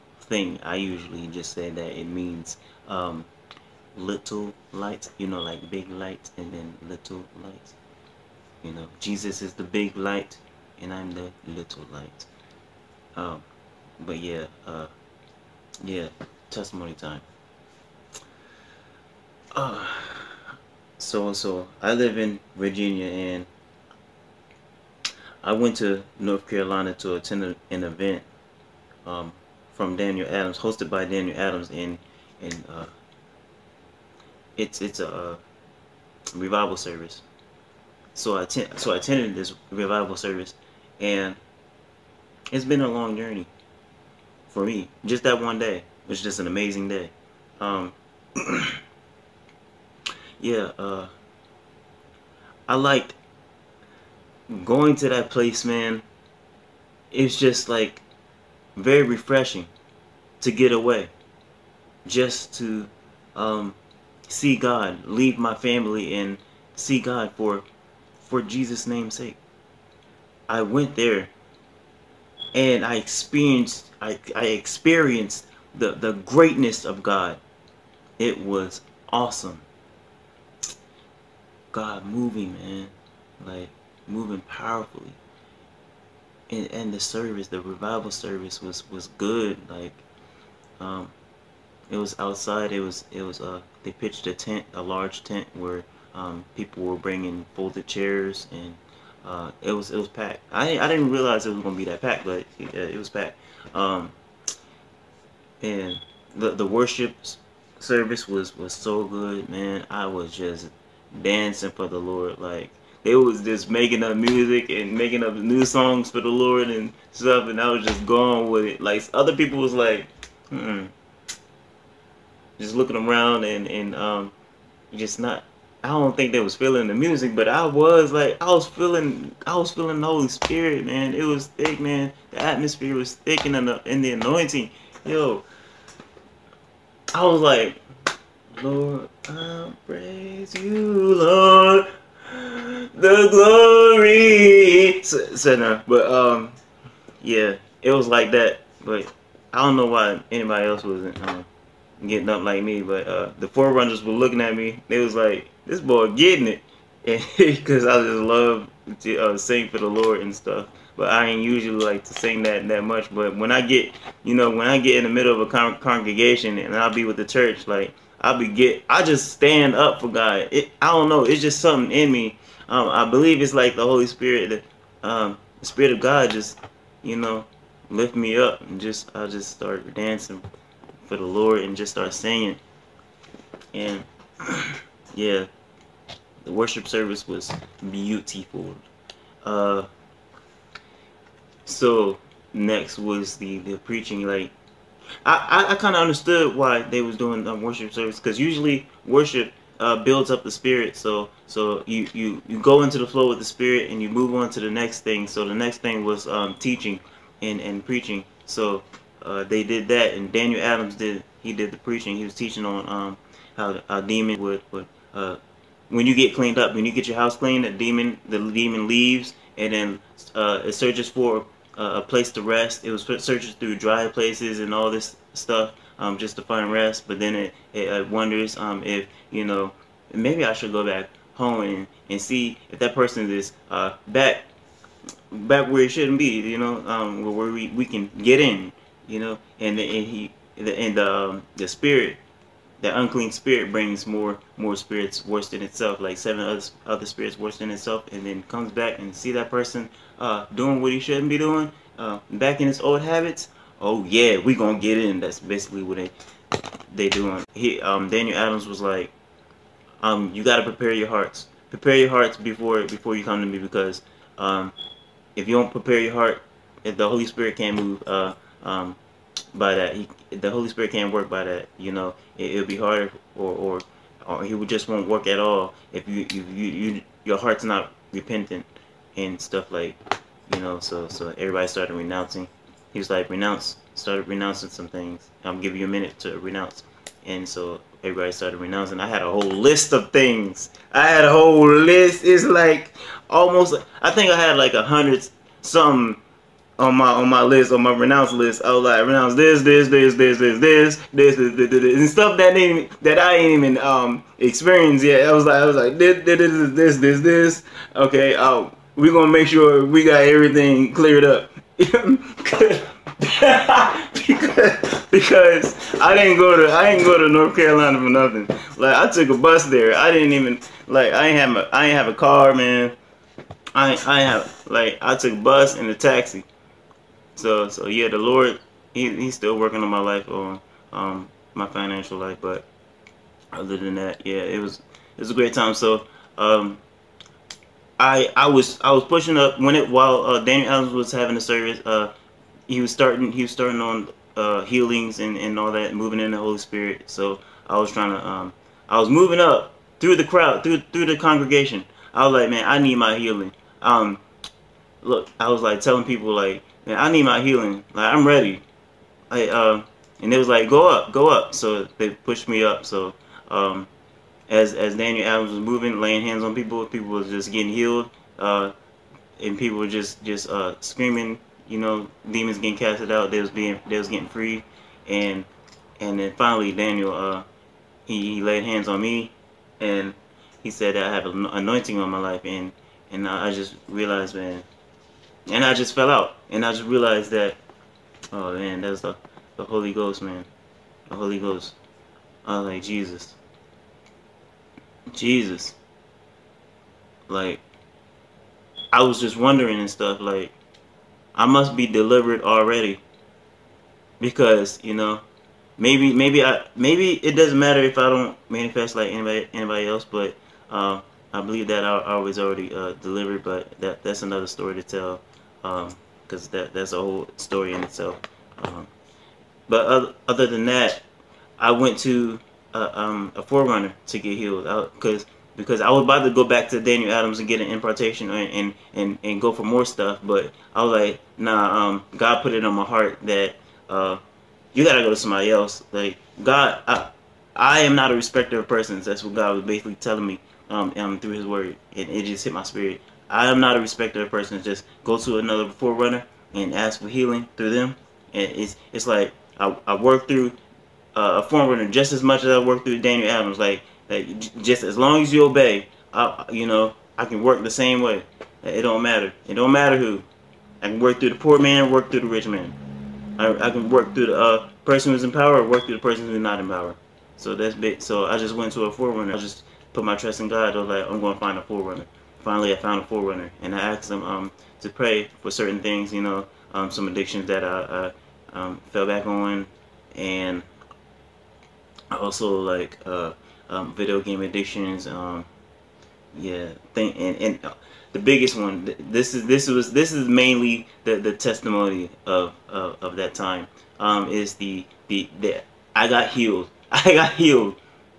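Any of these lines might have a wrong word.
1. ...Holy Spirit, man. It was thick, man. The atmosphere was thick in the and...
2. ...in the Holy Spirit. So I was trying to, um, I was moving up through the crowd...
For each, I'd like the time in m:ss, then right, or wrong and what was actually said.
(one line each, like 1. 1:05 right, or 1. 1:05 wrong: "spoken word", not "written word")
1. 2:10 right
2. 5:46 right.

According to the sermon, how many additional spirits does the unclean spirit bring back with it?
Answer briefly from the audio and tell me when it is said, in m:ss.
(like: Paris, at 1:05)
7, at 4:06.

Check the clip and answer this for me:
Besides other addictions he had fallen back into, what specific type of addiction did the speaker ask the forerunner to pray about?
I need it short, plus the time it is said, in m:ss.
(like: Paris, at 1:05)
video game addictions, at 8:03.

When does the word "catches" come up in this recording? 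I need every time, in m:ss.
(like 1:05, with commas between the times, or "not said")
not said.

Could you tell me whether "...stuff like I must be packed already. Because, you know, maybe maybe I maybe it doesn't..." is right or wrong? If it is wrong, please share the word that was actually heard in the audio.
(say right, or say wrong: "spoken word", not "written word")
wrong: "delivered", not "packed".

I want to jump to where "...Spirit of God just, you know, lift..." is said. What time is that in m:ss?
2:55.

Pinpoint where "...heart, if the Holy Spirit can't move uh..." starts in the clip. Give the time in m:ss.
4:26.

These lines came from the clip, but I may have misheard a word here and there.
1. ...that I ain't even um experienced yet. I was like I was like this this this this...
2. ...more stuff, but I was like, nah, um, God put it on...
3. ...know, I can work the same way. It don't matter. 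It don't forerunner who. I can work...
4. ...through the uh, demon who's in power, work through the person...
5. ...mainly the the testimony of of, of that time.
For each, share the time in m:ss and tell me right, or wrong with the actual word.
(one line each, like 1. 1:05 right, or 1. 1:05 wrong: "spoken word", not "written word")
1. 5:03 right
2. 7:09 right
3. 7:36 wrong: "matter", not "forerunner"
4. 7:44 wrong: "person", not "demon"
5. 8:10 right.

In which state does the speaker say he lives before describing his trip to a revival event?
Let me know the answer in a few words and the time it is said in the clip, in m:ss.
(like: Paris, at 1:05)
Virginia, at 0:22.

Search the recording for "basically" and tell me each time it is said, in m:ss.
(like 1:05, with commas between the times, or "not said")
4:15, 7:19.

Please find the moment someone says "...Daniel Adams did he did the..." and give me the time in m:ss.
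3:30.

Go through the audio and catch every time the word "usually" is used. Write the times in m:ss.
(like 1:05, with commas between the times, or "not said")
0:00, 2:41, 3:18.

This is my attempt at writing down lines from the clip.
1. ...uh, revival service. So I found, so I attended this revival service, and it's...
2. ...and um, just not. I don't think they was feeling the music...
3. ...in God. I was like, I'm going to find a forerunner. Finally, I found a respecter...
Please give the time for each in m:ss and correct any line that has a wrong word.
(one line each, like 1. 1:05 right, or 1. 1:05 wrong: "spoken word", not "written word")
1. 0:35 wrong: "attend", not "found"
2. 2:03 right
3. 7:50 wrong: "forerunner", not "respecter".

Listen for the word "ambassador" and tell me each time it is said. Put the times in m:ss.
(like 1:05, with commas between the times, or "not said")
not said.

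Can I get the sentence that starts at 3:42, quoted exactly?
It was searches through dry places and all this stuff um, just to find rest.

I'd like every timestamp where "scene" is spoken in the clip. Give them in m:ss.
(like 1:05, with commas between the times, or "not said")
not said.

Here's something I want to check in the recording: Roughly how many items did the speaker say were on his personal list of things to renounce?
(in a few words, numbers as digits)
a hundred some.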